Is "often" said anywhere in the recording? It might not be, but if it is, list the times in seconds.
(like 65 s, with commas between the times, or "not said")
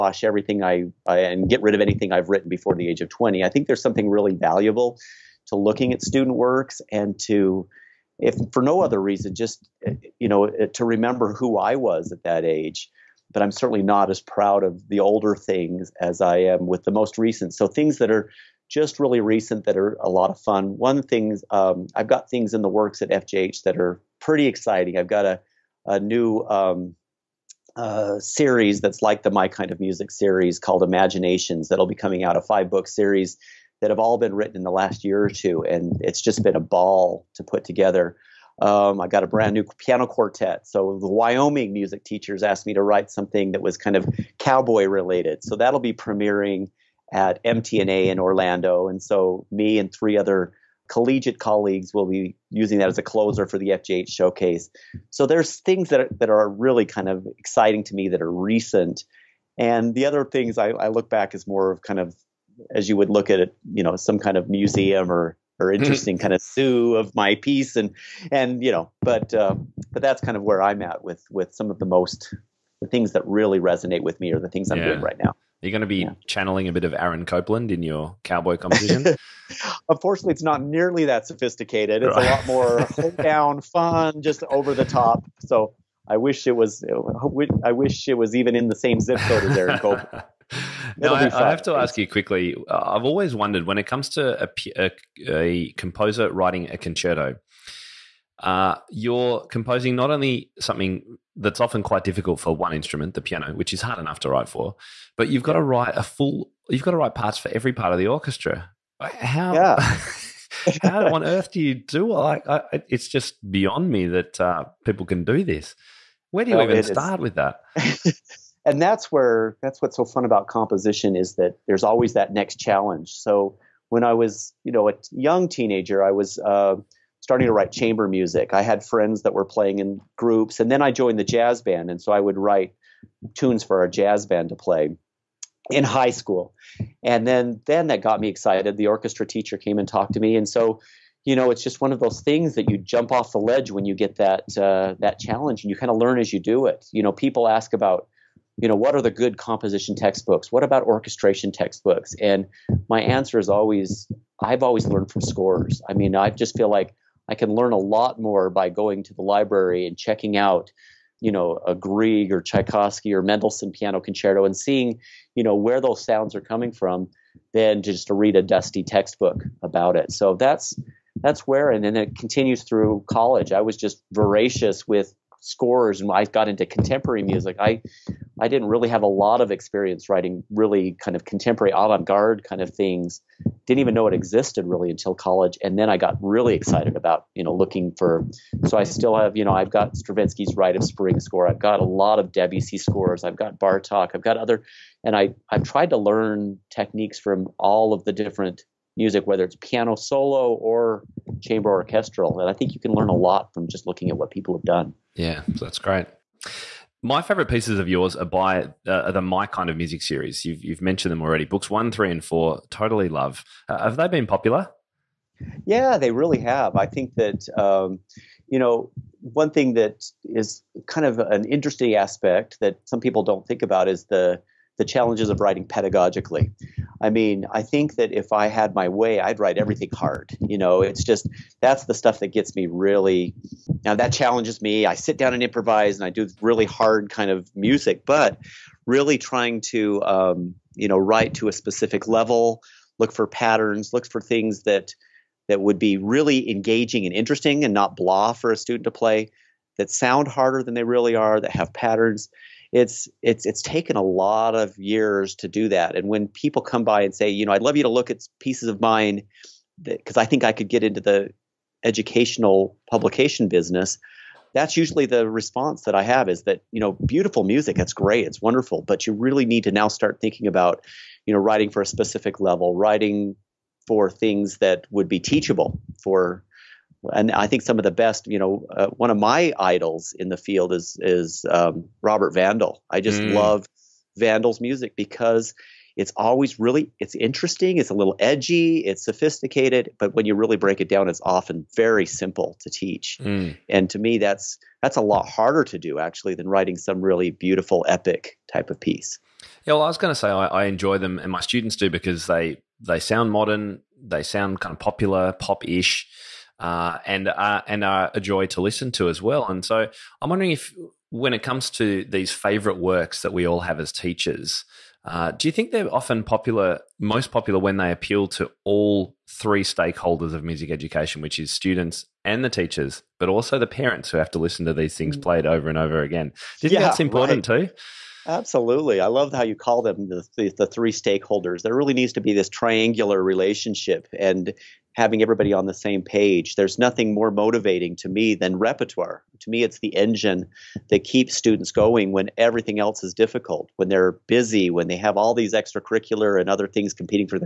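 101 s, 291 s, 315 s.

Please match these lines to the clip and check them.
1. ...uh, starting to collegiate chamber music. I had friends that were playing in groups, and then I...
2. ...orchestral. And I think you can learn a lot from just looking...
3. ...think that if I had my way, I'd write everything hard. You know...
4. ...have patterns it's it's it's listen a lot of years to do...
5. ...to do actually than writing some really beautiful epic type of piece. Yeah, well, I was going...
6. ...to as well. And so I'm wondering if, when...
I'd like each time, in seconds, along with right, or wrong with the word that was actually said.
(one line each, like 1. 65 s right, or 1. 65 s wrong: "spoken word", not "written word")
1. 126 s wrong: "write", not "collegiate"
2. 201 s right
3. 227 s right
4. 251 s wrong: "taken", not "listen"
5. 295 s right
6. 308 s right.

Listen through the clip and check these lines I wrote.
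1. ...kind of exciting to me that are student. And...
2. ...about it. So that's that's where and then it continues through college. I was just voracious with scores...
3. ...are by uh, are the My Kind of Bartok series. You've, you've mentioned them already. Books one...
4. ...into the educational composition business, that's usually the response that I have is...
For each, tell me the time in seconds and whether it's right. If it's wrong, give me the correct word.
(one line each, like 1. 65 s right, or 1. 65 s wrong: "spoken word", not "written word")
1. 56 s wrong: "recent", not "student"
2. 169 s right
3. 208 s wrong: "Music", not "Bartok"
4. 260 s wrong: "publication", not "composition".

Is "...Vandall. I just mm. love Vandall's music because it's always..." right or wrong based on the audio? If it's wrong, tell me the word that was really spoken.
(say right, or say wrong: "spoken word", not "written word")
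right.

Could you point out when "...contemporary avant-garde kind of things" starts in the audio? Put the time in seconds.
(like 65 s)
181 s.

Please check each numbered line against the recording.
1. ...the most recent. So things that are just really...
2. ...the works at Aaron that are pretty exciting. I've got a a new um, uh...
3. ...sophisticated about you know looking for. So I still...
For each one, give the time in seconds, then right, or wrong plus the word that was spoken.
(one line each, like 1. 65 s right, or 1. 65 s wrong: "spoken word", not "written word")
1. 16 s right
2. 22 s wrong: "FJH", not "Aaron"
3. 186 s wrong: "excited", not "sophisticated".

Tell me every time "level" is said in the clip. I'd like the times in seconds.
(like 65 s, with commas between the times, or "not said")
242 s, 272 s.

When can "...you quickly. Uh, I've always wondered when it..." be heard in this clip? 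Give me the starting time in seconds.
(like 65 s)
91 s.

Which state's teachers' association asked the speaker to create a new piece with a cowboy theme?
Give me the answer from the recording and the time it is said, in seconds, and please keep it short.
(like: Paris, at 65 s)
Wyoming, at 41 s.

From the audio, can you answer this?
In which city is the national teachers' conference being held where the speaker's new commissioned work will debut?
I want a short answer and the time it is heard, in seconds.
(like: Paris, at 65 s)
Orlando, at 48 s.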